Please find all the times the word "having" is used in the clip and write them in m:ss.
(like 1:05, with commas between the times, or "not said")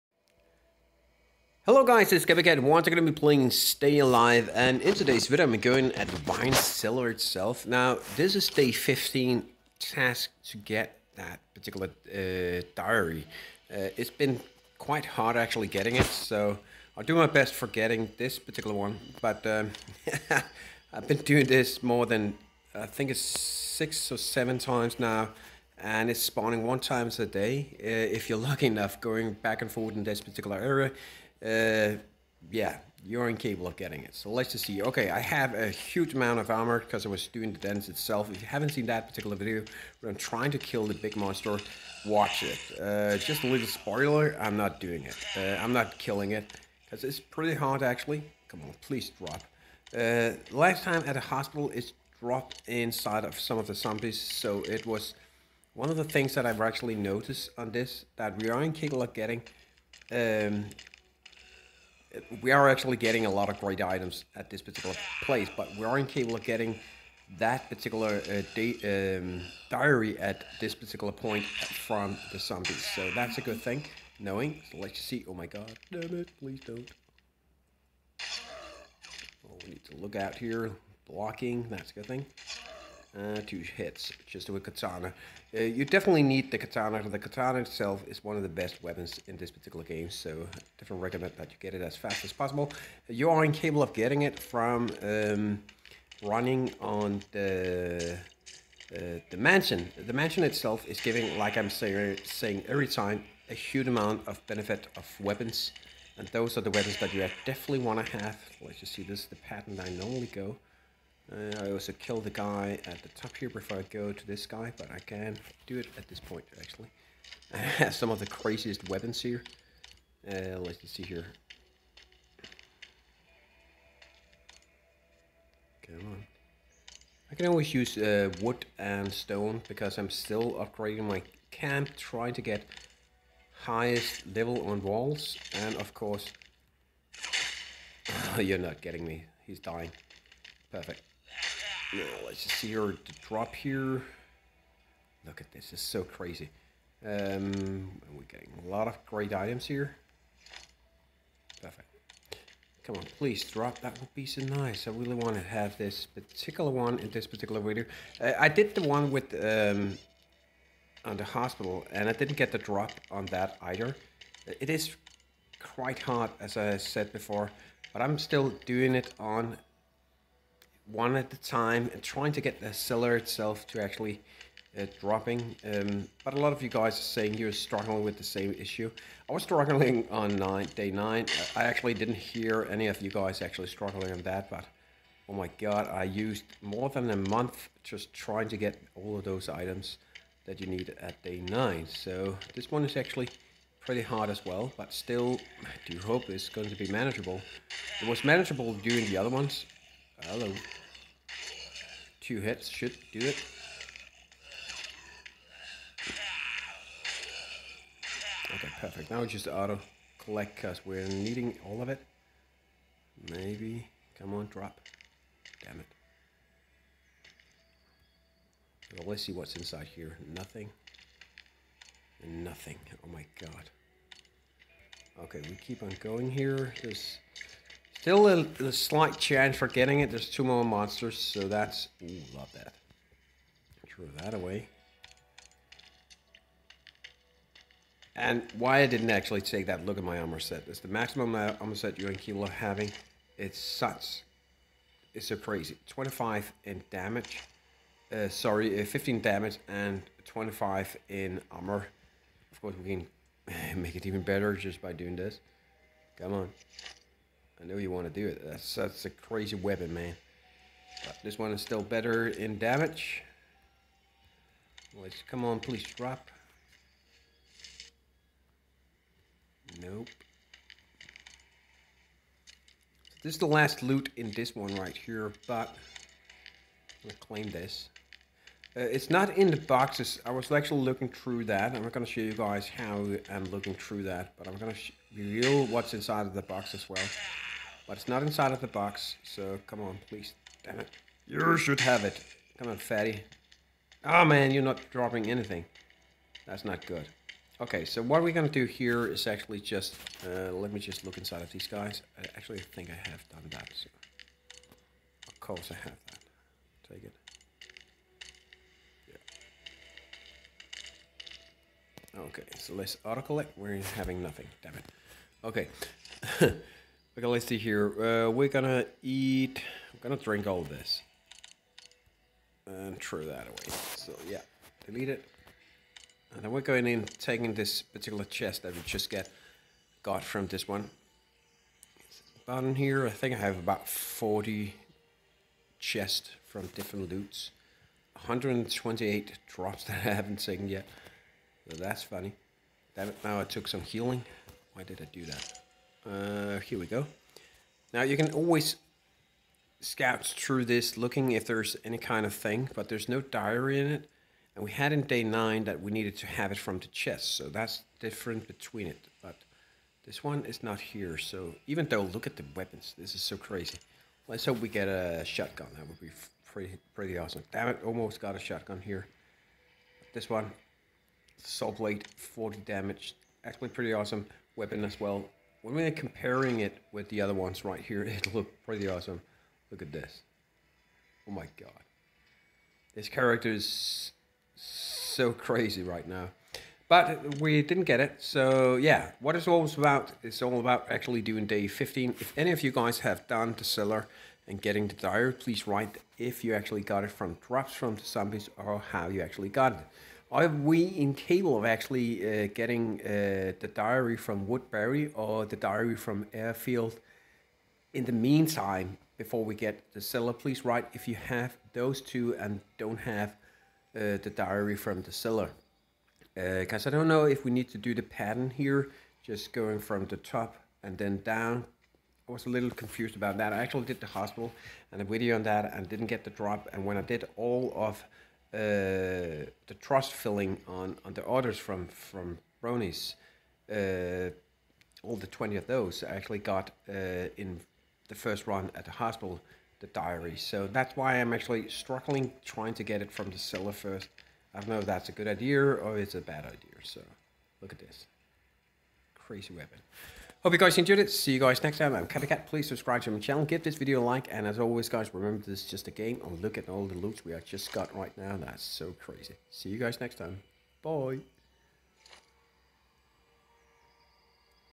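4:02, 5:13.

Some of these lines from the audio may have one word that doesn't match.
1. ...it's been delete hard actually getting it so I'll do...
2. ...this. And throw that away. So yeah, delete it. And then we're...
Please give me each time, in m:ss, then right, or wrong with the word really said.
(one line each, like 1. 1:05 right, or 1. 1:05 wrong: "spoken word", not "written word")
1. 0:13 wrong: "quite", not "delete"
2. 5:20 right.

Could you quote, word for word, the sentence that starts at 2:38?
Uh, I did the one with um, on the hospital, and I didn't get the drop on that either.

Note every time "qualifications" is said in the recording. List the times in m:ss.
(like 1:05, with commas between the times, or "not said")
not said.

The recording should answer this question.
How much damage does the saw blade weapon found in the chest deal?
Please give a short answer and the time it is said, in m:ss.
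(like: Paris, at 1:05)
40, at 6:12.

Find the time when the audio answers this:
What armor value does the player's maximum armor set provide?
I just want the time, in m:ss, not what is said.
4:10.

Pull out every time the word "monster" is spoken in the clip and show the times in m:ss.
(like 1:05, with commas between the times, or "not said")
0:41, 3:50.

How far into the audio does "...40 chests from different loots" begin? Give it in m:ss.
5:33.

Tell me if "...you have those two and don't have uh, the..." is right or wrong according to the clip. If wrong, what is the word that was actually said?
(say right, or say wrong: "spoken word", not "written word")
right.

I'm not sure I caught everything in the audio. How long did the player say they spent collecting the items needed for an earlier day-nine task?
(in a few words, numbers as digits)
More than a month.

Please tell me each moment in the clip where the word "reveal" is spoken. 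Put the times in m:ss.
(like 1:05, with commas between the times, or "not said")
4:45.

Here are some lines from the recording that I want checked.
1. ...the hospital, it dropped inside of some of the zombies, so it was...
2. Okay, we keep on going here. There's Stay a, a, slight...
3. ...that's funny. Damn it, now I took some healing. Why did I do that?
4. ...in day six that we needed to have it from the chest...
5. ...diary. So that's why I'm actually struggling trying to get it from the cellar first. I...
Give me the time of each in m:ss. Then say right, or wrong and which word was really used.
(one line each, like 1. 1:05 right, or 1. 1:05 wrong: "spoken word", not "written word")
1. 0:51 right
2. 3:45 wrong: "Still", not "Stay"
3. 5:41 right
4. 5:54 wrong: "nine", not "six"
5. 7:19 right.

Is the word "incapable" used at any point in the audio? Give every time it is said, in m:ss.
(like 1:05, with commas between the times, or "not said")
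0:33, 0:58, 1:33, 6:40.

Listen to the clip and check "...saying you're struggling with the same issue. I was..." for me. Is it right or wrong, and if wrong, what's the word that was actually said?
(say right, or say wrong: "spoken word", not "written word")
right.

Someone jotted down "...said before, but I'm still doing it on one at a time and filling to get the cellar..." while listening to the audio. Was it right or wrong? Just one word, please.
wrong.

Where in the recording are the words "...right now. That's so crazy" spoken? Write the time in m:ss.
7:37.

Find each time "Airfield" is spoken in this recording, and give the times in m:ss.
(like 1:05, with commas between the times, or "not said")
6:46.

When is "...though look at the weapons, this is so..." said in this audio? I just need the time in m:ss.
6:01.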